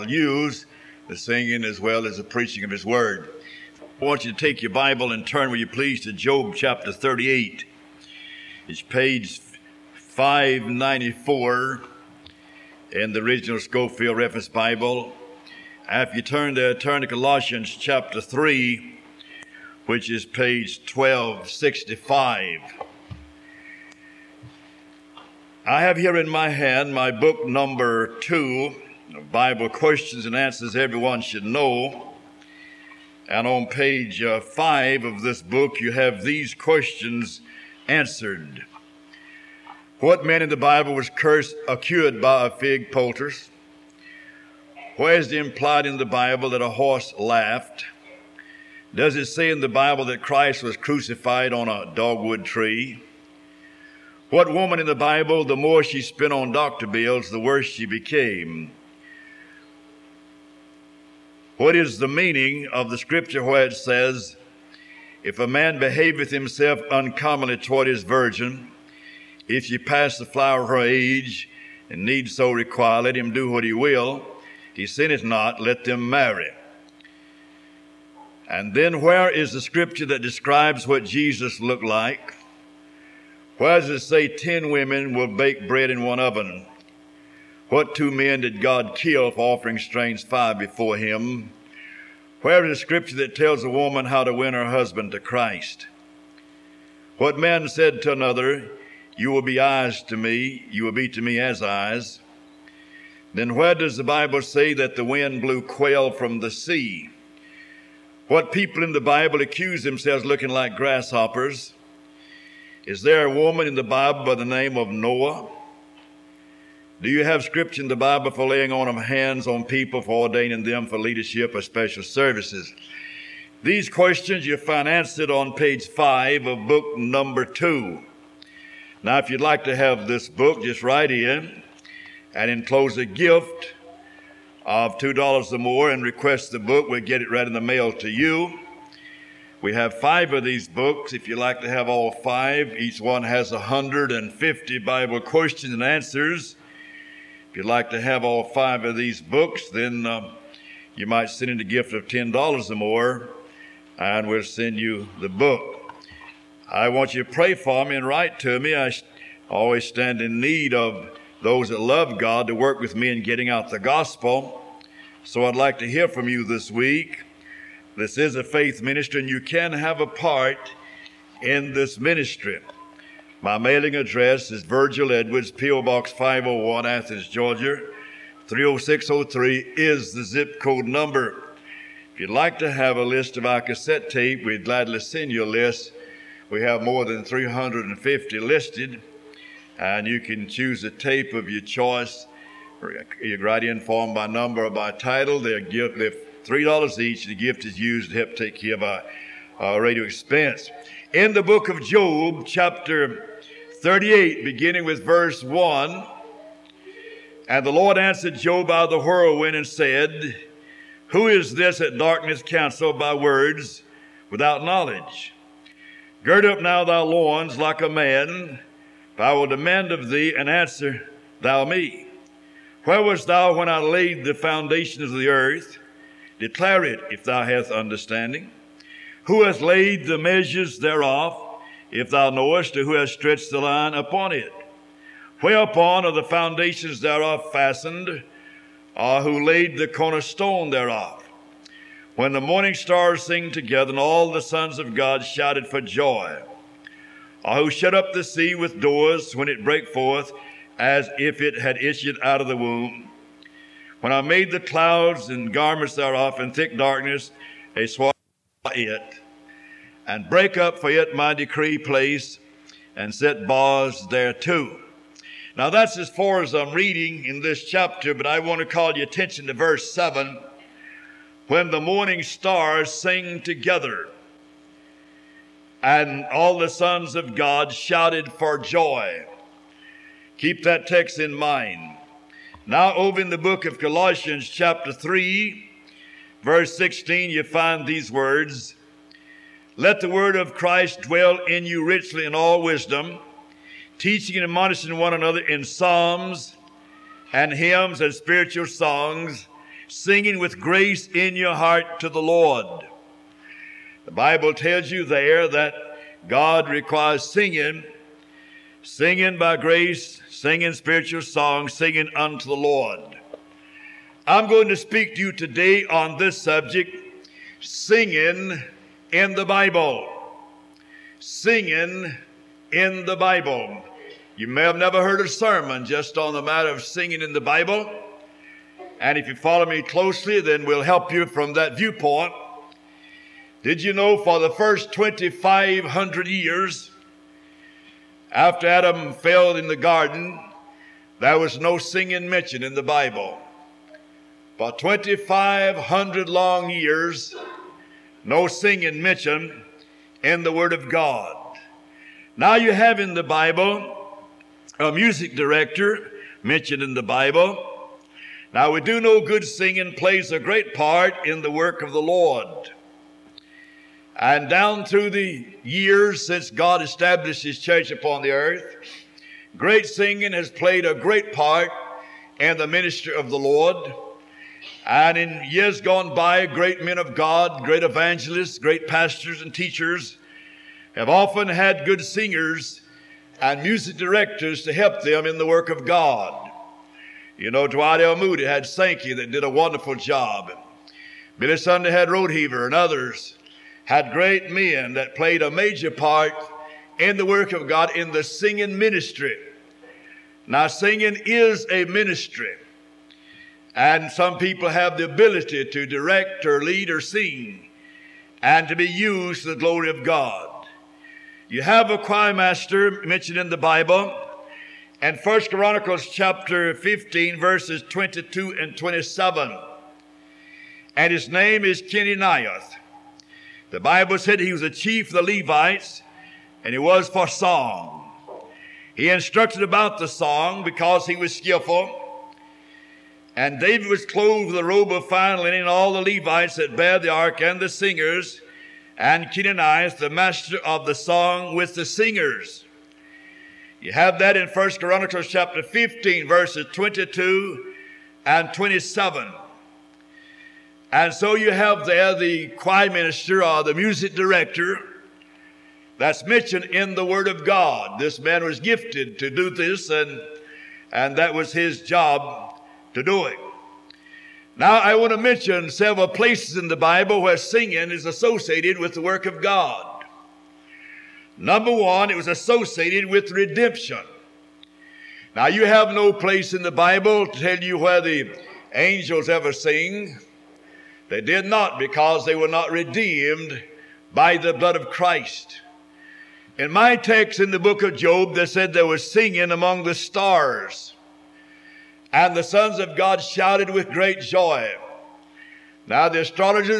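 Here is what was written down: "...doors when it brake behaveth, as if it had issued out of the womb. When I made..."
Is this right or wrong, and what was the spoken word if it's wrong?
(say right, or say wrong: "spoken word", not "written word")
wrong: "forth", not "behaveth".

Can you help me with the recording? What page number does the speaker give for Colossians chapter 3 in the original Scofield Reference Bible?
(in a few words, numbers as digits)
1265.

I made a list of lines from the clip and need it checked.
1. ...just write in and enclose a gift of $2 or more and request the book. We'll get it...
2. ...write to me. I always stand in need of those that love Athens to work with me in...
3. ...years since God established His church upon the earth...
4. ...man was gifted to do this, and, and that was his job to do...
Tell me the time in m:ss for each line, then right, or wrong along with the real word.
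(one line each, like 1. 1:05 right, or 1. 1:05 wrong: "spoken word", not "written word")
1. 2:10 right
2. 2:38 wrong: "God", not "Athens"
3. 6:05 right
4. 7:38 right.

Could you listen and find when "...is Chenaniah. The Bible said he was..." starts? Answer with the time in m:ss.
7:01.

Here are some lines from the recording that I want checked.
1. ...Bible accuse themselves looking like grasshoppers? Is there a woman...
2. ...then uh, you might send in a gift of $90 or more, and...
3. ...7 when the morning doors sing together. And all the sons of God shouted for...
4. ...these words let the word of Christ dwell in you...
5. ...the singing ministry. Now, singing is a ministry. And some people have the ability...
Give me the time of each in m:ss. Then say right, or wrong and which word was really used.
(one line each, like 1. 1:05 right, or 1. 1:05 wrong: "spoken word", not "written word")
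1. 1:49 right
2. 2:29 wrong: "10", not "90"
3. 4:29 wrong: "stars", not "doors"
4. 4:47 right
5. 6:38 right.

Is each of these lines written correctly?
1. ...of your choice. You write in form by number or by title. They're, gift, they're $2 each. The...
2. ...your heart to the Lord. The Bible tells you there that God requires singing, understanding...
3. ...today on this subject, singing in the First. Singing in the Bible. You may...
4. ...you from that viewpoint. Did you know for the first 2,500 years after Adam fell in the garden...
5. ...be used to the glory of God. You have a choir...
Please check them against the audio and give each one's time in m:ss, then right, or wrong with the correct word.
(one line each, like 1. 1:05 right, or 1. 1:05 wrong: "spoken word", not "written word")
1. 3:11 wrong: "3", not "2"
2. 5:01 wrong: "singing", not "understanding"
3. 5:15 wrong: "Bible", not "First"
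4. 5:31 right
5. 6:48 right.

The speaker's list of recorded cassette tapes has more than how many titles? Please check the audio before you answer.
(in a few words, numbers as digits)
350.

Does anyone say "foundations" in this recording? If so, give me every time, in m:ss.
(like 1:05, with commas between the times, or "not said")
3:44, 3:56.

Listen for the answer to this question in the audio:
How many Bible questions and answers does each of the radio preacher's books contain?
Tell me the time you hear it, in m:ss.
2:23.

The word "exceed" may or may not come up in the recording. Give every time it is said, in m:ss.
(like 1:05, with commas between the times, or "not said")
not said.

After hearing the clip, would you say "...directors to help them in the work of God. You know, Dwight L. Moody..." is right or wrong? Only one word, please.
right.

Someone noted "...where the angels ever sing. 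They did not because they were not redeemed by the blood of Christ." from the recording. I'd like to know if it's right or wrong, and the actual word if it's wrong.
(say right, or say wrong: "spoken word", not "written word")
right.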